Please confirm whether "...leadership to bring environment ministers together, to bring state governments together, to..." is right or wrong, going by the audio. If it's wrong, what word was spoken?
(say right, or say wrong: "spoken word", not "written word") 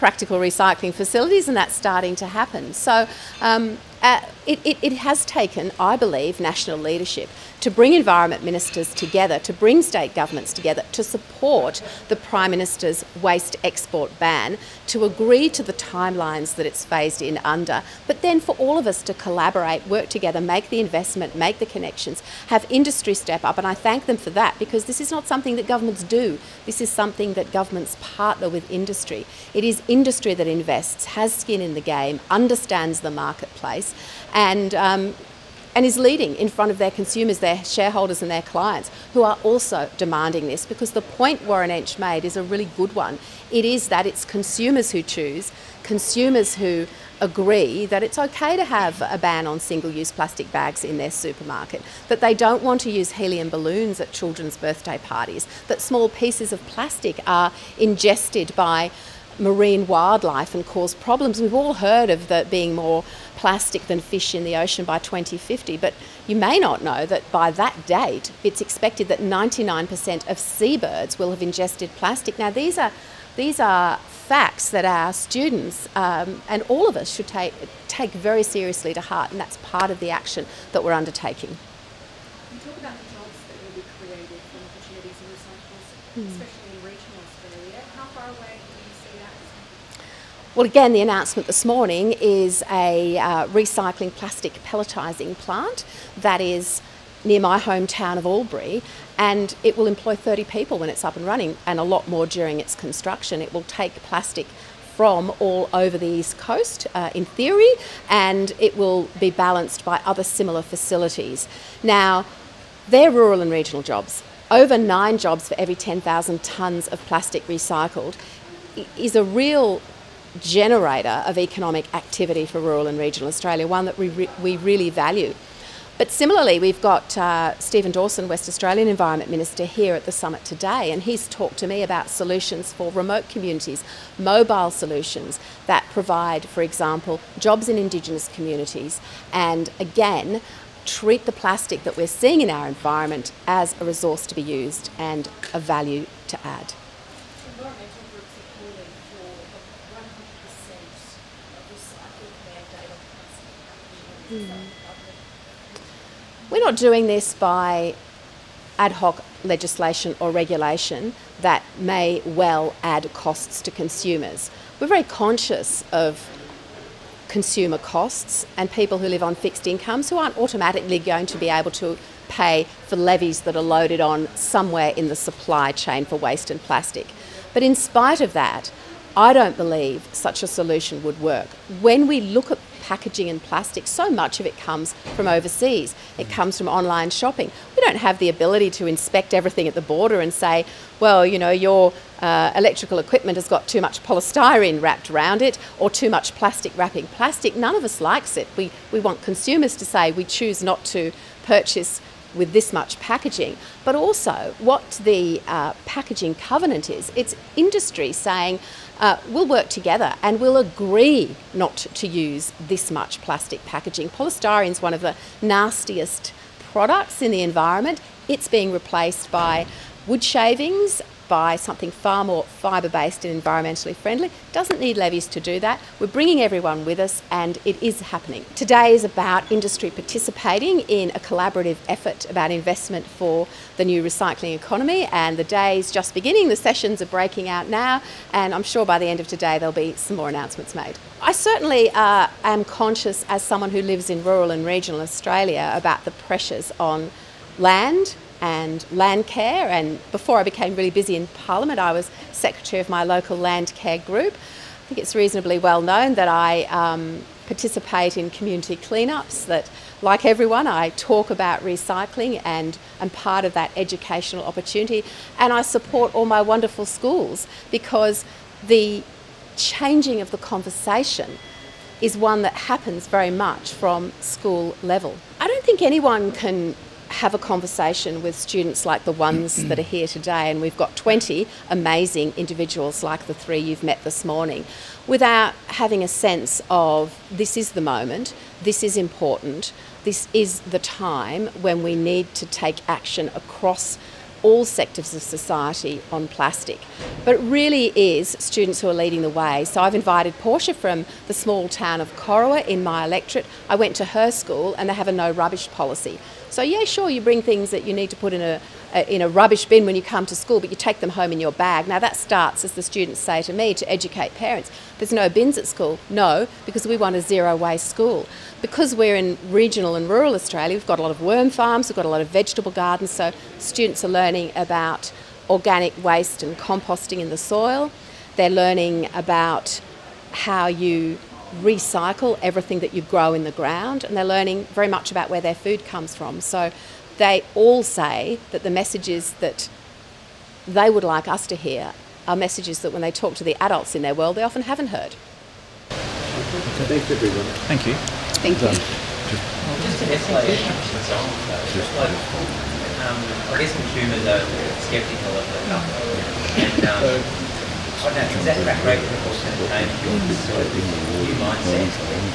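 right.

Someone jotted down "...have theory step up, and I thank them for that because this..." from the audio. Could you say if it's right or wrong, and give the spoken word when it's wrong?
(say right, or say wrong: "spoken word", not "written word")
wrong: "industry", not "theory".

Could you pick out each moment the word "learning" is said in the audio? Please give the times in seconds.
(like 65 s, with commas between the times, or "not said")
324 s, 328 s, 334 s.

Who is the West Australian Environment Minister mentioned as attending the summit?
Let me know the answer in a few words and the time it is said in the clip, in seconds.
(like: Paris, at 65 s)
Stephen Dawson, at 127 s.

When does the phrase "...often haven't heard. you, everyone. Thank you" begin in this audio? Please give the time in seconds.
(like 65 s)
344 s.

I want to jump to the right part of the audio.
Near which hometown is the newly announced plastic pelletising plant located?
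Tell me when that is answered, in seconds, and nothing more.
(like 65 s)
98 s.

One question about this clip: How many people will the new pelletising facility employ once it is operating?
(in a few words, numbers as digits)
30.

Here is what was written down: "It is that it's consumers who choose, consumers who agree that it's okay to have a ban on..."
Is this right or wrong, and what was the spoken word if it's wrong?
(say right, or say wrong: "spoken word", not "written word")
right.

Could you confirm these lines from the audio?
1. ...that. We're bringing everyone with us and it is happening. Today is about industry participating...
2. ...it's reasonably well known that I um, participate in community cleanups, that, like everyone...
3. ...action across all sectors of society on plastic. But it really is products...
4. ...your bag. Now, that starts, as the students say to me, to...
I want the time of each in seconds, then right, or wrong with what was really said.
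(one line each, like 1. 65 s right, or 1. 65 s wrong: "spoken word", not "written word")
1. 225 s right
2. 254 s right
3. 292 s wrong: "students", not "products"
4. 311 s right.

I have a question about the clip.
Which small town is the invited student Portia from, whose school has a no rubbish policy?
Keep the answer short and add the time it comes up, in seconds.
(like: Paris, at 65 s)
Corowa, at 302 s.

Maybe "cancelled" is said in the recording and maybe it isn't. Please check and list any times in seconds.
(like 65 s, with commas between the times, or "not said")
not said.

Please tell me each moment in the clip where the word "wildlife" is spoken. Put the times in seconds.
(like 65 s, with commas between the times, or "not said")
59 s.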